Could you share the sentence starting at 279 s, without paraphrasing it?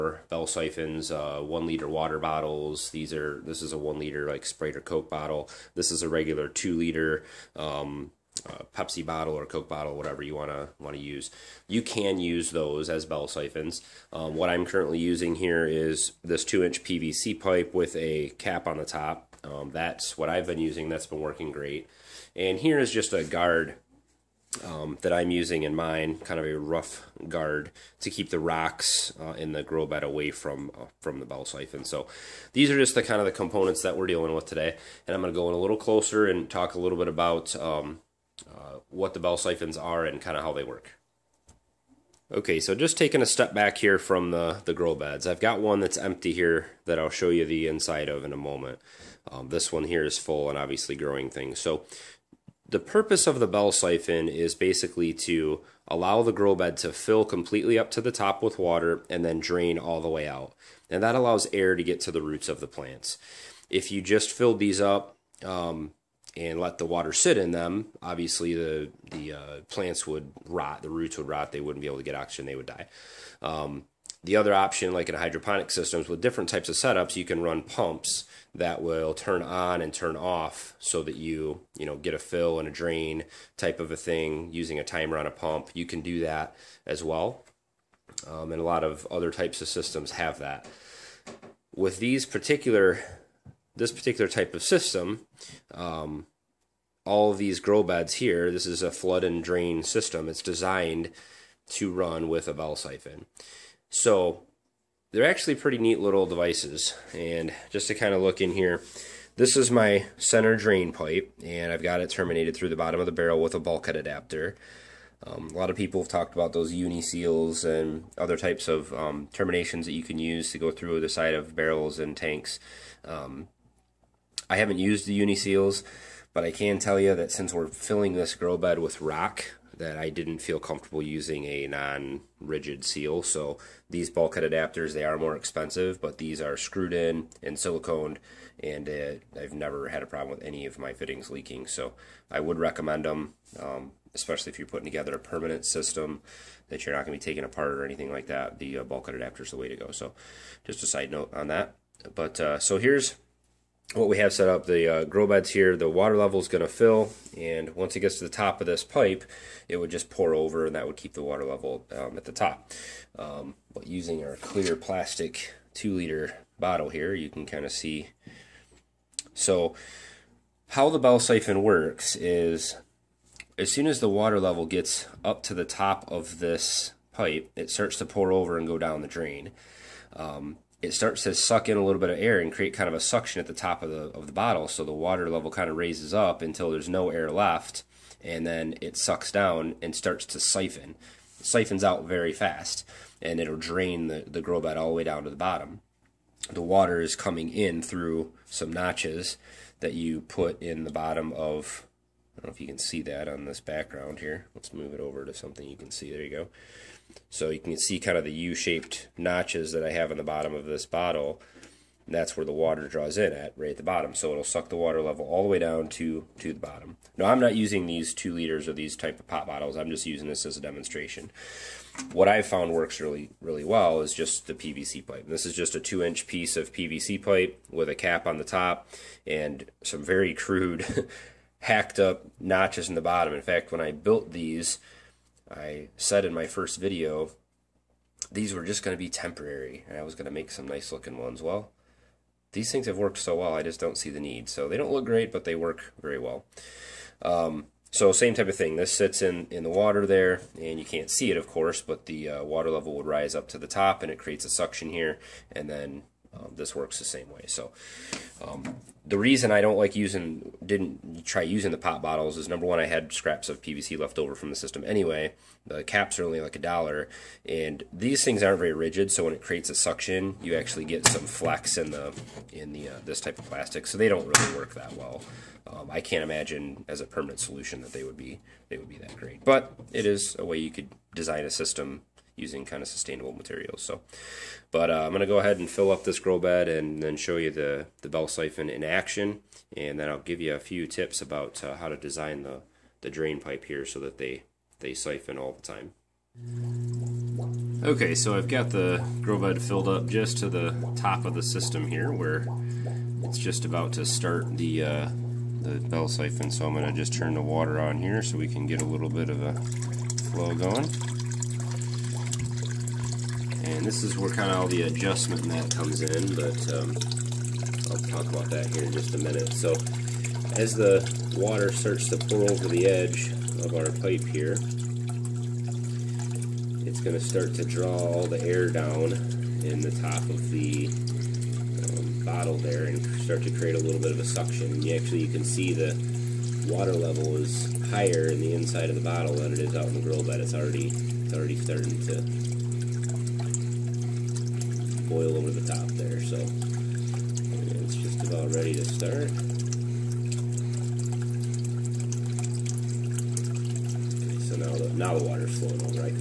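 But it is a way you could design a system using kind of sustainable materials.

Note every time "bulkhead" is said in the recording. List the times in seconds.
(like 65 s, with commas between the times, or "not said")
113 s, 134 s, 148 s.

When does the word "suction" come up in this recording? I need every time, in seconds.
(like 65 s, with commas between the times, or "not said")
182 s, 254 s, 269 s, 334 s.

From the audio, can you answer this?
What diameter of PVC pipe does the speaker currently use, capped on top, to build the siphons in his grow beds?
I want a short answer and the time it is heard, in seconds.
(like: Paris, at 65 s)
2 inch, at 16 s.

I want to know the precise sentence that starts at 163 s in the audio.
Um, but using our clear plastic 2-liter bottle here, you can kind of see.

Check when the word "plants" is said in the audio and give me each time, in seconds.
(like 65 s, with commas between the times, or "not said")
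62 s, 69 s.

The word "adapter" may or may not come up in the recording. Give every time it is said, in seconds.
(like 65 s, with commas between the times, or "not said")
113 s, 134 s, 149 s.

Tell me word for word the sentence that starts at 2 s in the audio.
These are, this is a one liter like Sprite or Coke bottle.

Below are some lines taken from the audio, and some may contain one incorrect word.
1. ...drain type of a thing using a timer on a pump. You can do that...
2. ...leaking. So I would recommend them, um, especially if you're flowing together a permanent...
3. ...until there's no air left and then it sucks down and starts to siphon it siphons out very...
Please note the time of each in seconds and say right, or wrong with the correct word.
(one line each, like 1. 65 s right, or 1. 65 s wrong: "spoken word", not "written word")
1. 82 s right
2. 141 s wrong: "putting", not "flowing"
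3. 186 s right.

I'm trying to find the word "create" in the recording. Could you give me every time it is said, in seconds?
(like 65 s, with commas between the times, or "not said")
182 s, 254 s, 269 s, 333 s.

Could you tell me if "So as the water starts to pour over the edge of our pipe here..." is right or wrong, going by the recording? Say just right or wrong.
right.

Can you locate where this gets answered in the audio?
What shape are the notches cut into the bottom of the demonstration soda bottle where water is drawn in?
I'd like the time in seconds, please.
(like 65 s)
208 s.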